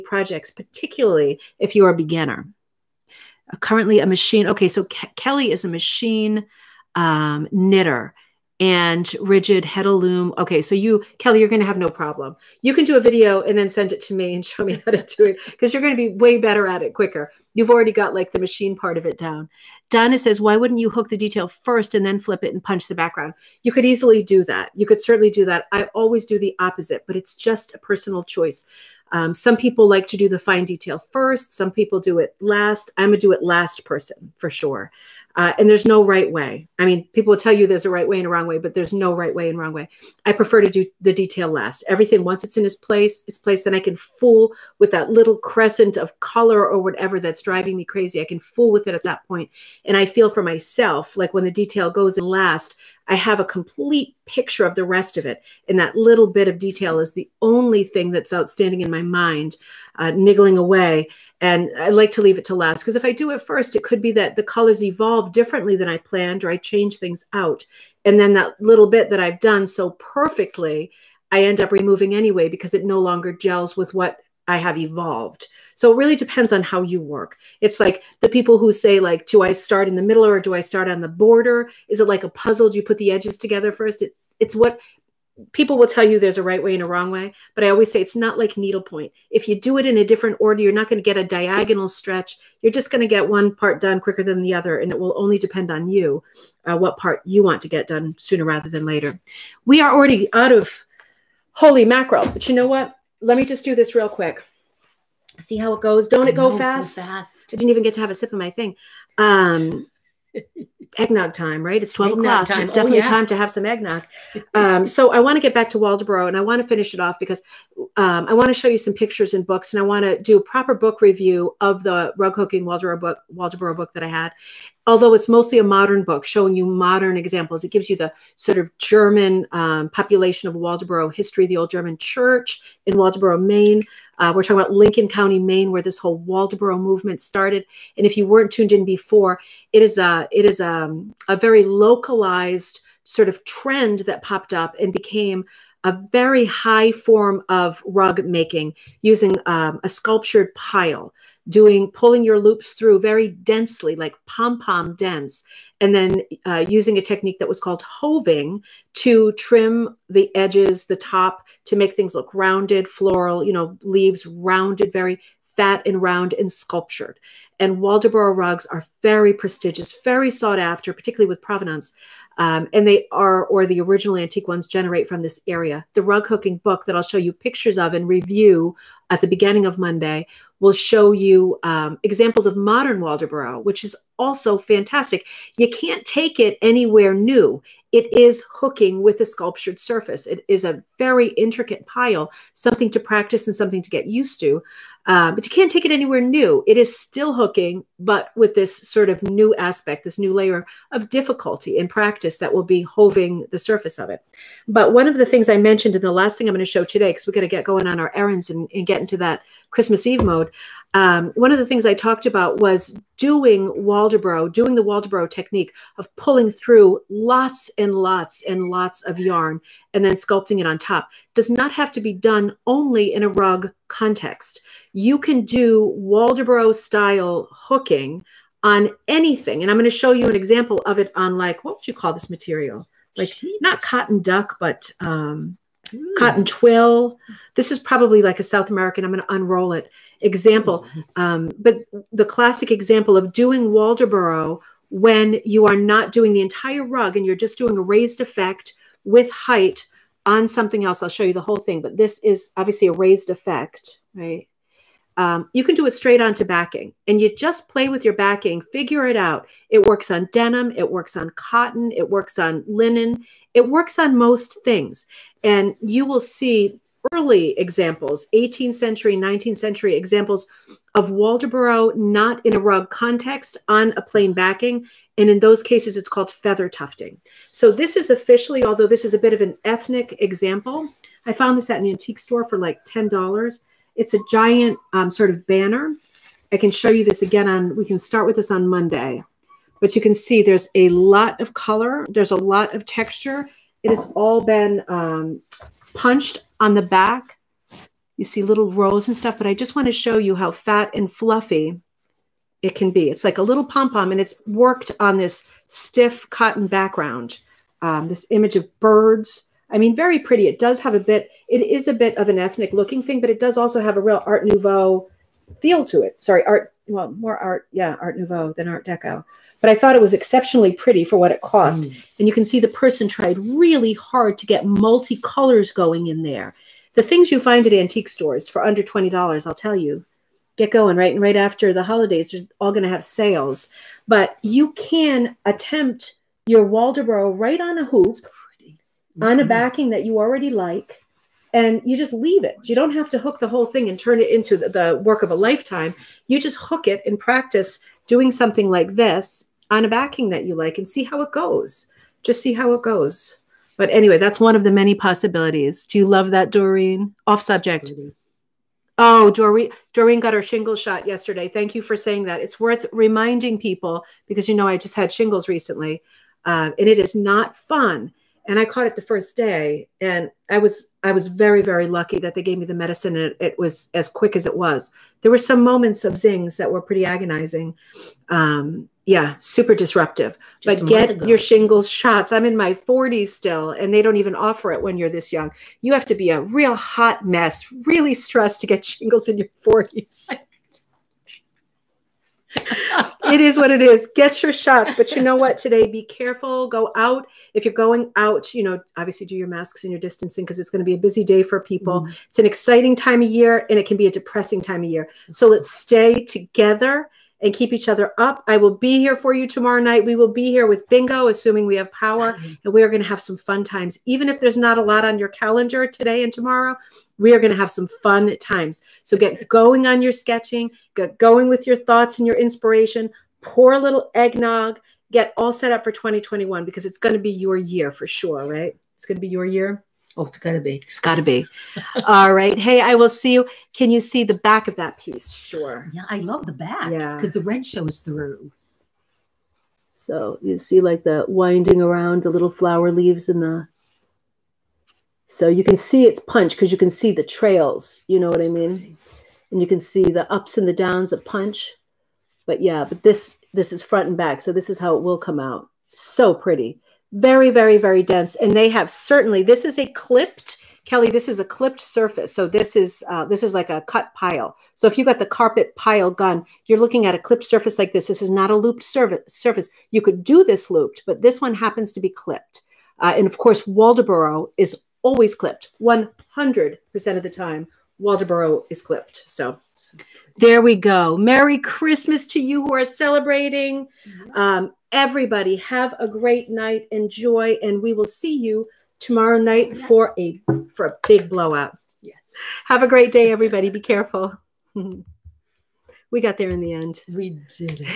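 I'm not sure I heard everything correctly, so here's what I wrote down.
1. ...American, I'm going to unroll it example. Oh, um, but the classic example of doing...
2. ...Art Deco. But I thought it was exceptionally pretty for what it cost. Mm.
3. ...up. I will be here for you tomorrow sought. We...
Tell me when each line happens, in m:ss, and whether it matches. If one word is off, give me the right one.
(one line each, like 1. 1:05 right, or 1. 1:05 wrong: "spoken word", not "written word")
1. 3:58 right
2. 5:18 right
3. 6:48 wrong: "night", not "sought".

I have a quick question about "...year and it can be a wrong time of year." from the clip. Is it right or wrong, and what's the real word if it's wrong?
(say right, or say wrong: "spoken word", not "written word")
wrong: "depressing", not "wrong".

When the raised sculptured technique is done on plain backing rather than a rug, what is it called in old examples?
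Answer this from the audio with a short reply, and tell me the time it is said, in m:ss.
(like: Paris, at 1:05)
feather tufting, at 4:36.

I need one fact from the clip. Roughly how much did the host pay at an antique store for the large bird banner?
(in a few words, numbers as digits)
$10.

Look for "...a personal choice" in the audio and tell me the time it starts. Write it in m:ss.
0:27.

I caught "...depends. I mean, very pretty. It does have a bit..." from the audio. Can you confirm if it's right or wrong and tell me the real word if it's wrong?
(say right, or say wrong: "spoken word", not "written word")
wrong: "birds", not "depends".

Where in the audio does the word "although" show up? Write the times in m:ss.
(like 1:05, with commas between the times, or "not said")
2:04, 4:38.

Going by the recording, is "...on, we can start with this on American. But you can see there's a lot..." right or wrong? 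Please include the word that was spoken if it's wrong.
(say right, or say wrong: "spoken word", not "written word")
wrong: "Monday", not "American".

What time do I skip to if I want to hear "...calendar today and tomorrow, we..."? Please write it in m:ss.
6:55.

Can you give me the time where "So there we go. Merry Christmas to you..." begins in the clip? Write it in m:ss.
7:59.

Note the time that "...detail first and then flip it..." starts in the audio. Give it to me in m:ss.
0:21.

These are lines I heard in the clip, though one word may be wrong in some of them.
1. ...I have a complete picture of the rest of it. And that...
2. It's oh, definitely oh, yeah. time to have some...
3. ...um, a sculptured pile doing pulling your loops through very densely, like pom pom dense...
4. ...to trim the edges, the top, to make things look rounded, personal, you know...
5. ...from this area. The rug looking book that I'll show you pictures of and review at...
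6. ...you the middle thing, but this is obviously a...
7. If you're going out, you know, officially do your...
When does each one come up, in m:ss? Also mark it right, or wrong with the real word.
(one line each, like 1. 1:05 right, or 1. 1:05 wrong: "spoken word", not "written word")
1. 0:53 right
2. 1:52 right
3. 2:29 right
4. 2:38 wrong: "floral", not "personal"
5. 2:55 wrong: "hooking", not "looking"
6. 4:11 wrong: "whole", not "middle"
7. 6:37 wrong: "obviously", not "officially".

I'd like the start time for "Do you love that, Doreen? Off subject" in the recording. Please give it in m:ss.
5:55.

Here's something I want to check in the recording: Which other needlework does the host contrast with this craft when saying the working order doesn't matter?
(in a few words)
needlepoint.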